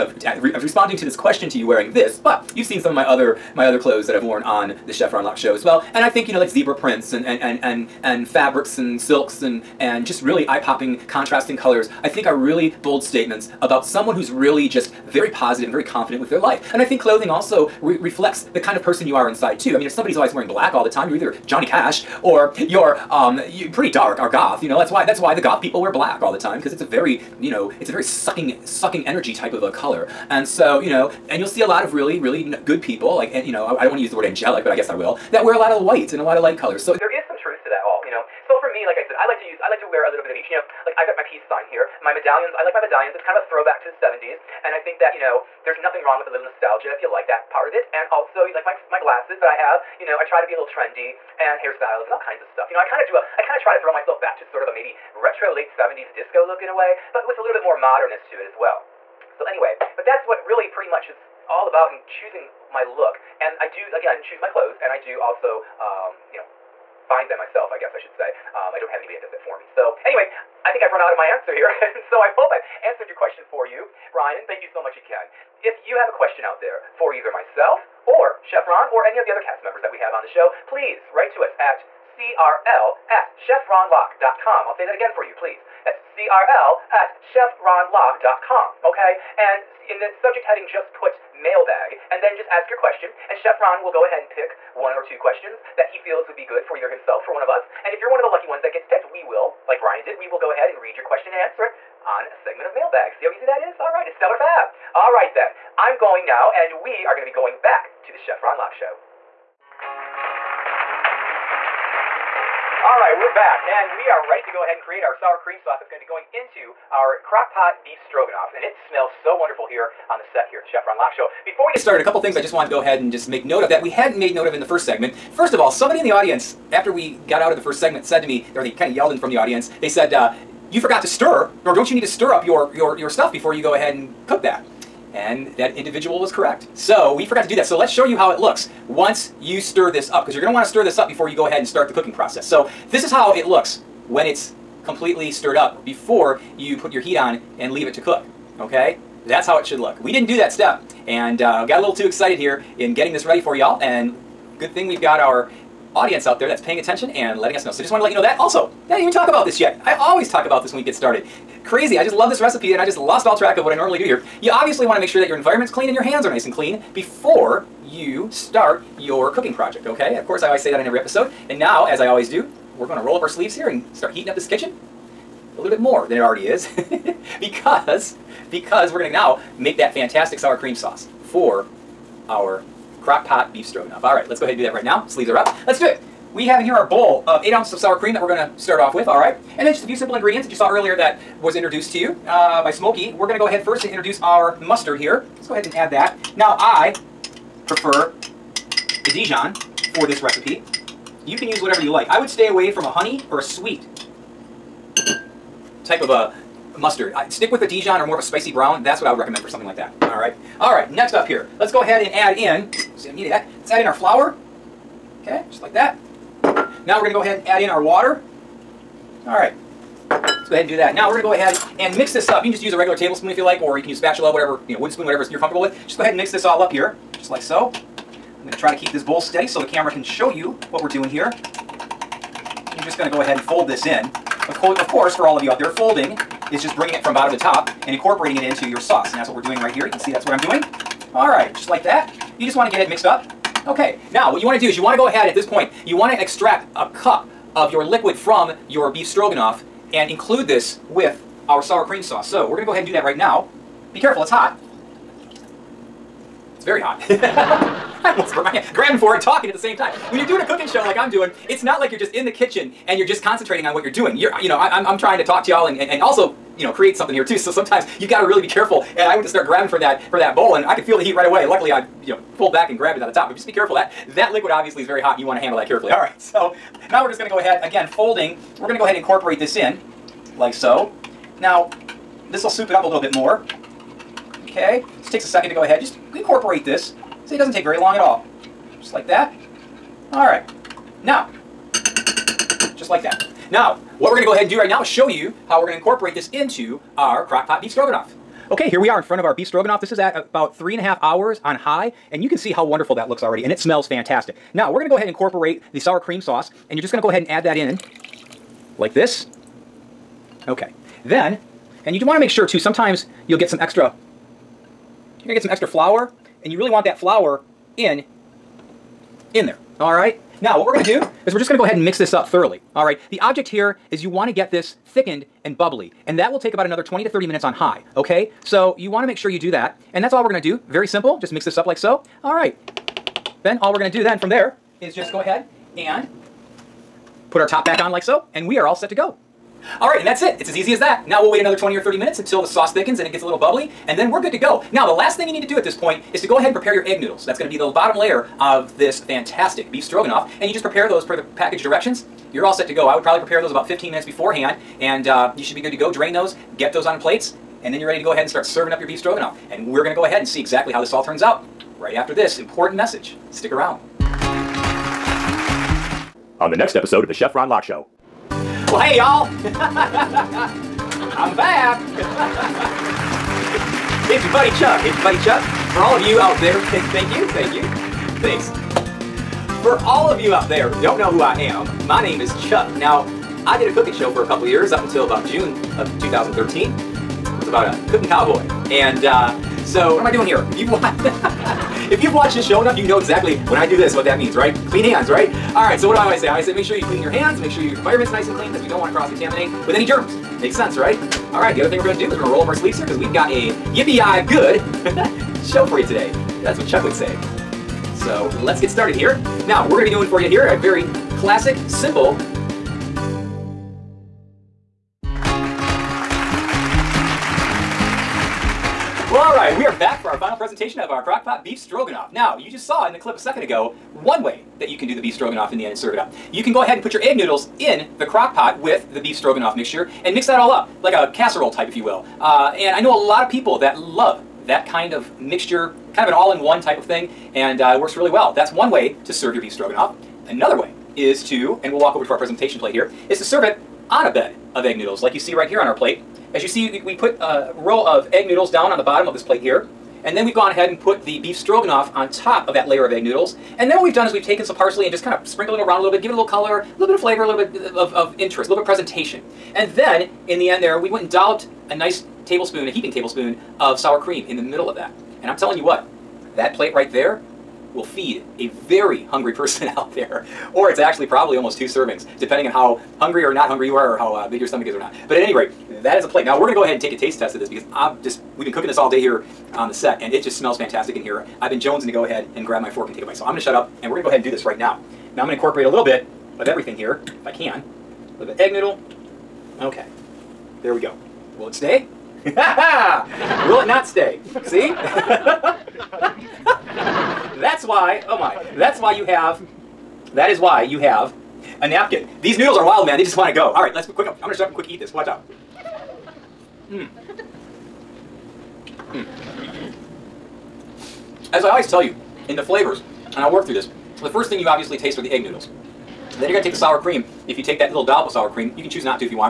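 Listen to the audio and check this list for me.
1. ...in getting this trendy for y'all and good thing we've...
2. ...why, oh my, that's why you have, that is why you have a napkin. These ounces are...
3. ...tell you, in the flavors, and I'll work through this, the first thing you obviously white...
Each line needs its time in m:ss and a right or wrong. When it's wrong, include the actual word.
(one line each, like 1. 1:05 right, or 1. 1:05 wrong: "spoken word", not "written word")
1. 2:32 wrong: "ready", not "trendy"
2. 8:17 wrong: "noodles", not "ounces"
3. 8:31 wrong: "taste", not "white".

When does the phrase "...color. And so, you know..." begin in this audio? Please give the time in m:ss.
0:29.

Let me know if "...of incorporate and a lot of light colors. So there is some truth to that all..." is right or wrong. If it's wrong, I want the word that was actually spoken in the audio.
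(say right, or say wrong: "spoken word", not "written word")
wrong: "white", not "incorporate".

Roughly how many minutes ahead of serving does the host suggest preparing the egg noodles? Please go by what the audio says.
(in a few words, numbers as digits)
15 minutes.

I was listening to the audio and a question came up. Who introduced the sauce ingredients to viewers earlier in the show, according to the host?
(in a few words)
Smokey.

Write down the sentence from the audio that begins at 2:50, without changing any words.
Of course, I always say that in every episode.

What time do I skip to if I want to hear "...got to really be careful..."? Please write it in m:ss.
4:28.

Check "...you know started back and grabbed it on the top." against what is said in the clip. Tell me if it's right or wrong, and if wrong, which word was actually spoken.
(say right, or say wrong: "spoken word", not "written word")
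wrong: "pulled", not "started".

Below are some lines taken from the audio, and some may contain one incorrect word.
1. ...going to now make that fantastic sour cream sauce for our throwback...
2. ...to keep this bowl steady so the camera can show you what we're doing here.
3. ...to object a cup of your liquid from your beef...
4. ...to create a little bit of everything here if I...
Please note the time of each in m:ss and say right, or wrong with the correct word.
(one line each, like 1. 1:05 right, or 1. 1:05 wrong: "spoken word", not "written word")
1. 2:58 wrong: "crock", not "throwback"
2. 3:48 right
3. 4:06 wrong: "extract", not "object"
4. 8:05 wrong: "incorporate", not "create".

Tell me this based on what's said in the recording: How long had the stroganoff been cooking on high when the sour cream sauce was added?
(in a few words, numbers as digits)
3.5 hours.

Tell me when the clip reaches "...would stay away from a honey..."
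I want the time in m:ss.
3:22.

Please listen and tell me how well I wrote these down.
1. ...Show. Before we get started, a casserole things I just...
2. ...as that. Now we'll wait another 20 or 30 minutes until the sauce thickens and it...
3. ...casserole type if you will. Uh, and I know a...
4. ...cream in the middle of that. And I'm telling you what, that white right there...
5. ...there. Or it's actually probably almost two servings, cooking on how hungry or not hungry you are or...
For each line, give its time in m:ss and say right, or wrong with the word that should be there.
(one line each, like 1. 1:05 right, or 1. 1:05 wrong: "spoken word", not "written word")
1. 2:01 wrong: "couple", not "casserole"
2. 5:40 right
3. 7:11 right
4. 7:43 wrong: "plate", not "white"
5. 7:49 wrong: "depending", not "cooking".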